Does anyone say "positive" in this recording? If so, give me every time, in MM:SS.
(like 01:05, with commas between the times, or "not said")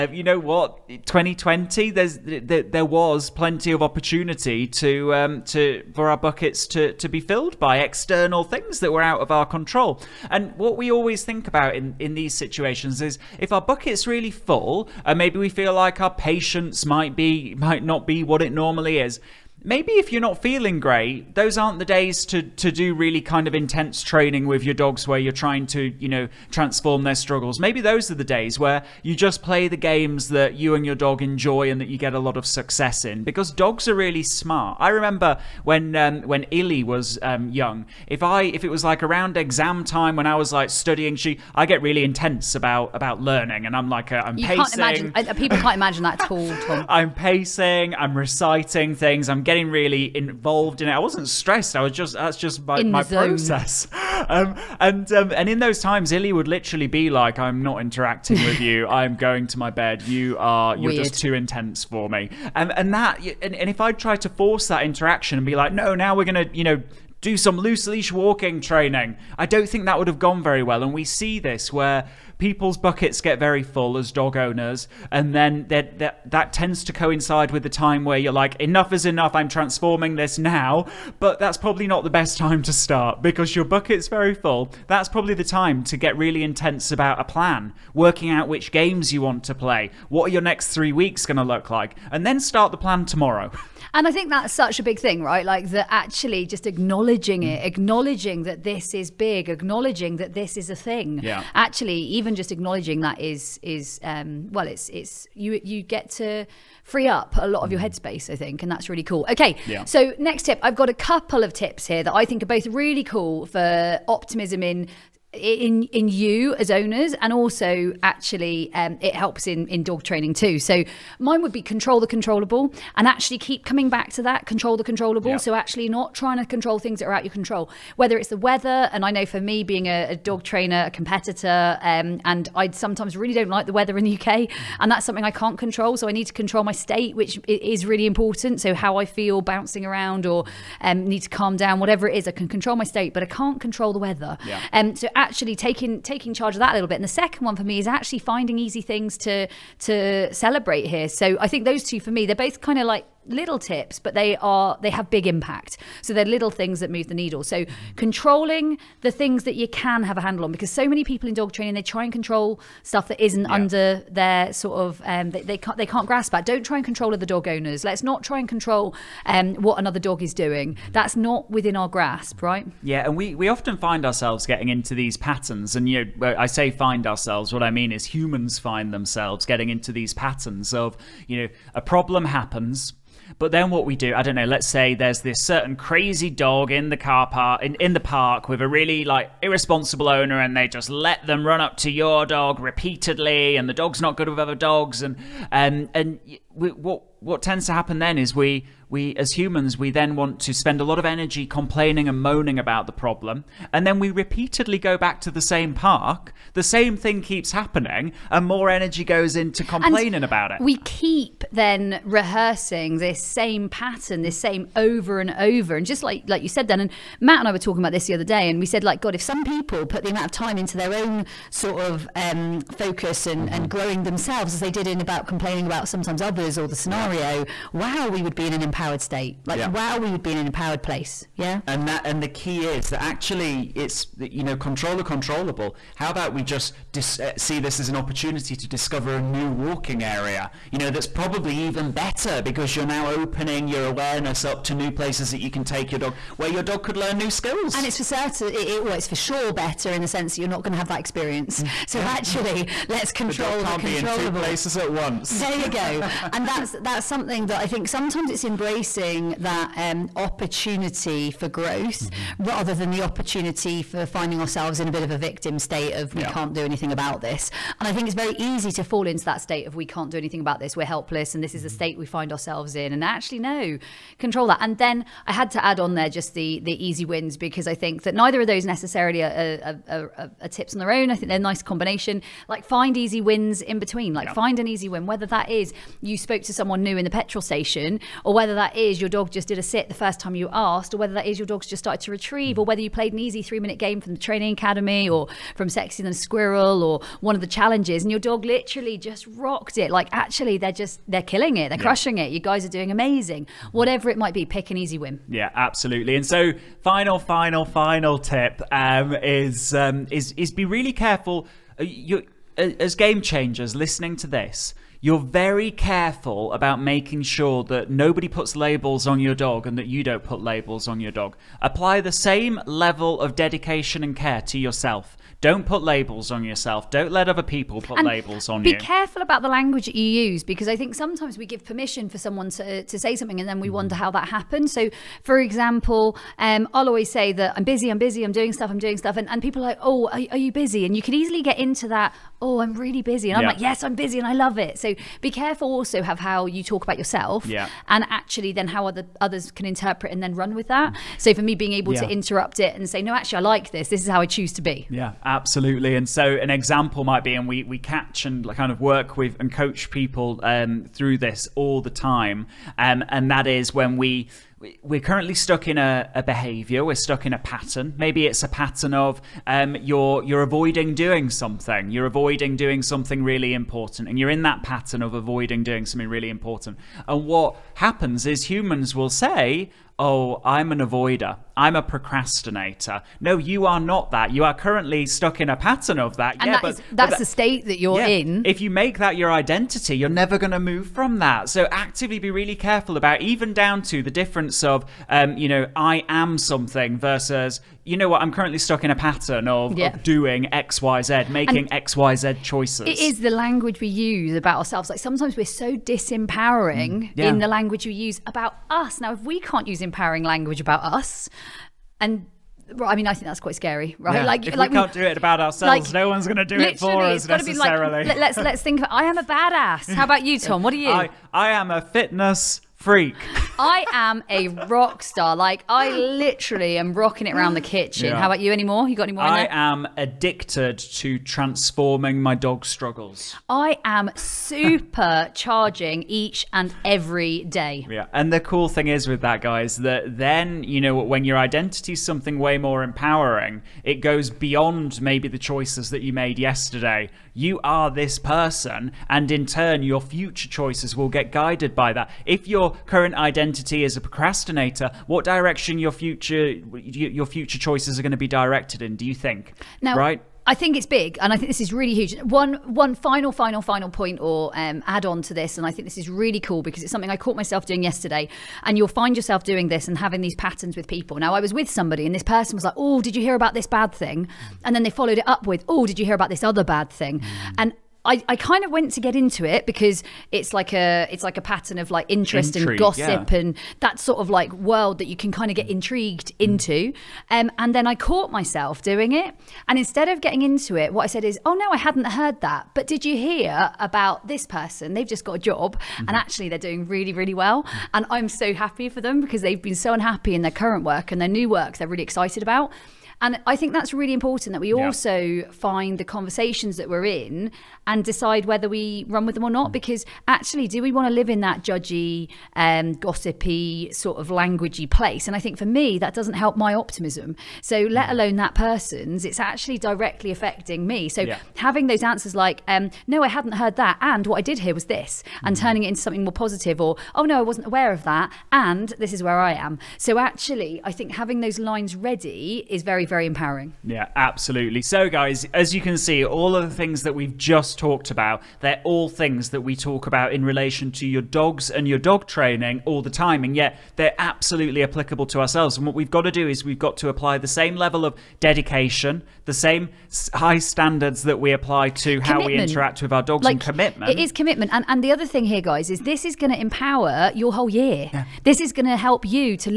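08:46.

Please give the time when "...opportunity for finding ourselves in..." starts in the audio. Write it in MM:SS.
04:23.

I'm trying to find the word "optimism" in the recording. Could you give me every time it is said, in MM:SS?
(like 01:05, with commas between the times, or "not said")
01:54, 08:36.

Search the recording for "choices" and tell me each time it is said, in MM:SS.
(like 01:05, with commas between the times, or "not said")
06:42, 07:25, 07:30, 07:37.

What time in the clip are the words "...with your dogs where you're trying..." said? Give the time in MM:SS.
00:24.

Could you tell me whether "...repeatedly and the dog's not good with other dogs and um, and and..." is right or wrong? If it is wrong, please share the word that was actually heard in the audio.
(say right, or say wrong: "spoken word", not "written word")
right.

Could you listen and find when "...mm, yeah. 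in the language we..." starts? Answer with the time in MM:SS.
06:47.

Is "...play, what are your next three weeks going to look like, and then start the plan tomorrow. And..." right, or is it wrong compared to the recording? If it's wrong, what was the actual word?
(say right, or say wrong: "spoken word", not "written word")
right.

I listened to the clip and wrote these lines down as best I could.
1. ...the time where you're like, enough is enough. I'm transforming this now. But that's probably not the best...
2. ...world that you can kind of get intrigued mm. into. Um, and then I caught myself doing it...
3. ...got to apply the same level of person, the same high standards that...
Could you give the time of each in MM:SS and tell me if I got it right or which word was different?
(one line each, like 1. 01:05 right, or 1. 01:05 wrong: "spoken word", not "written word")
1. 01:17 right
2. 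08:04 right
3. 09:06 wrong: "dedication", not "person".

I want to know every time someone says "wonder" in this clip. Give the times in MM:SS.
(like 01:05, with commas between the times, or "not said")
05:33.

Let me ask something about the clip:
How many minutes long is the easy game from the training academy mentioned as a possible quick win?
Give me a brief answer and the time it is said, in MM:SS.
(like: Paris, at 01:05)
3, at 04:53.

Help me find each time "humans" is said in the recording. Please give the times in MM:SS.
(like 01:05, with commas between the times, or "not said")
02:58, 03:19, 06:18.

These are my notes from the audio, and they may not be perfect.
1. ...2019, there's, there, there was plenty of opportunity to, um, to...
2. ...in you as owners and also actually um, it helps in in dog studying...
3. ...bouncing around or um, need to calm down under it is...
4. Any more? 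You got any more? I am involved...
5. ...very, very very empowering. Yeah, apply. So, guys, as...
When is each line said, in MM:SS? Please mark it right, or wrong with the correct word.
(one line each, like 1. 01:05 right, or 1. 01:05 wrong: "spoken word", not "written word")
1. 00:00 wrong: "2020", not "2019"
2. 01:55 wrong: "training", not "studying"
3. 02:19 wrong: "whatever", not "under"
4. 07:08 wrong: "addicted", not "involved"
5. 08:52 wrong: "absolutely", not "apply".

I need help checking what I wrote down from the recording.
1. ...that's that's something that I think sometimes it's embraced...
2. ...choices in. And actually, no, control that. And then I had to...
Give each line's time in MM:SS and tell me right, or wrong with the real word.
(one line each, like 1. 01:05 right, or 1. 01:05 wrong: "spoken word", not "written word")
1. 04:16 right
2. 04:32 wrong: "ourselves", not "choices".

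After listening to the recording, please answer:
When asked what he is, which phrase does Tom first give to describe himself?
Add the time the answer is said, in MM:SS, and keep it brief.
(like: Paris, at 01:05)
fitness freak, at 07:01.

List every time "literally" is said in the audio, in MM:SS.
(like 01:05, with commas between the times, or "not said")
00:56, 04:58, 07:05.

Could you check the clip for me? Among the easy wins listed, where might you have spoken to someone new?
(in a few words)
petrol station.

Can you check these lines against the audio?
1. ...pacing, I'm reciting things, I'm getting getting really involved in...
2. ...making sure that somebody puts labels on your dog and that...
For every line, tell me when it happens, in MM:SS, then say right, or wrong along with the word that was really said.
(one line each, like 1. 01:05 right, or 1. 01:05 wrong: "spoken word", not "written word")
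1. 00:47 right
2. 05:16 wrong: "nobody", not "somebody".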